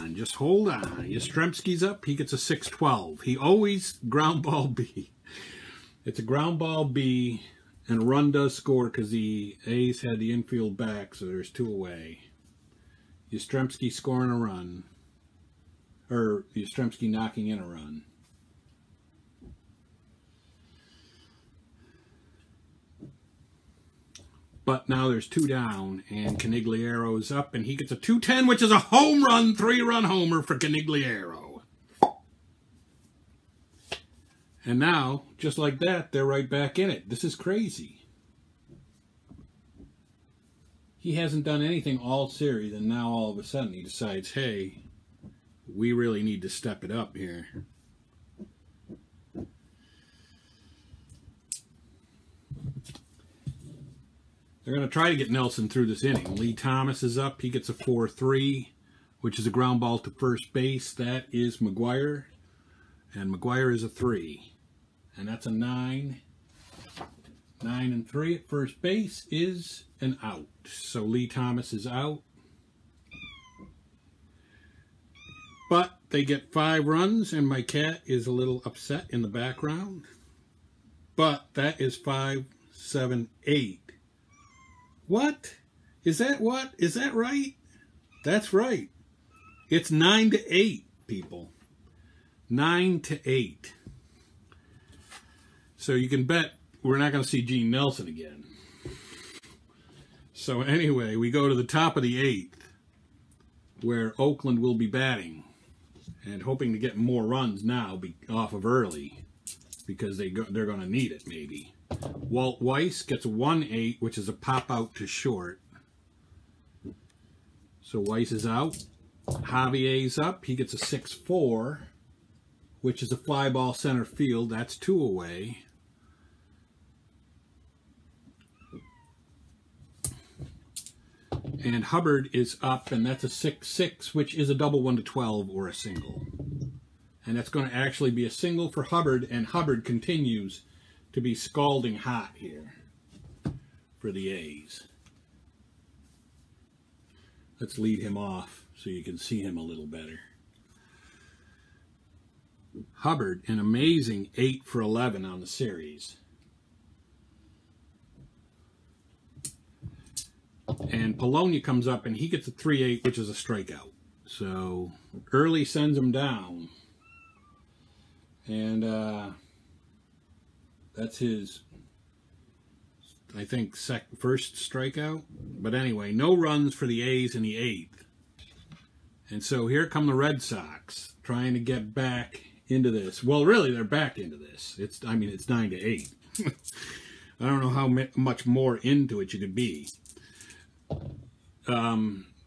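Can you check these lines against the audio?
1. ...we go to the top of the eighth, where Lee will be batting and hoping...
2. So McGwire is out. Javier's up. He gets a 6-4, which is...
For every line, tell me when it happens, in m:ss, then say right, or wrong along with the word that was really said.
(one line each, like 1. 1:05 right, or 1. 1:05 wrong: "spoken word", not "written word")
1. 1:41 wrong: "Oakland", not "Lee"
2. 1:57 wrong: "Weiss", not "McGwire".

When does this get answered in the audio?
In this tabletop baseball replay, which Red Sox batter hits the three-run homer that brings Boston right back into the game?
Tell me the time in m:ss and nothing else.
0:30.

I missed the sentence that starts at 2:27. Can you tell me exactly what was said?
Let's lead him off so you can see him a little better.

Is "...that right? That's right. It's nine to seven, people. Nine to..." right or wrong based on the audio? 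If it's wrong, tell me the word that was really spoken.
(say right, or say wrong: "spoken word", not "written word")
wrong: "eight", not "seven".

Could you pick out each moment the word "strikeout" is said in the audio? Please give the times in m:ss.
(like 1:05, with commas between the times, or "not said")
2:43, 2:54.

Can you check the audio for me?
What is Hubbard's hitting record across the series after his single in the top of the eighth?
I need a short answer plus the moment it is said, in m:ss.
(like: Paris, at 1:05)
8 for 11, at 2:34.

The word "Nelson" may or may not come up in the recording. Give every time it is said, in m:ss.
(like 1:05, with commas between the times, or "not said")
0:55, 1:37.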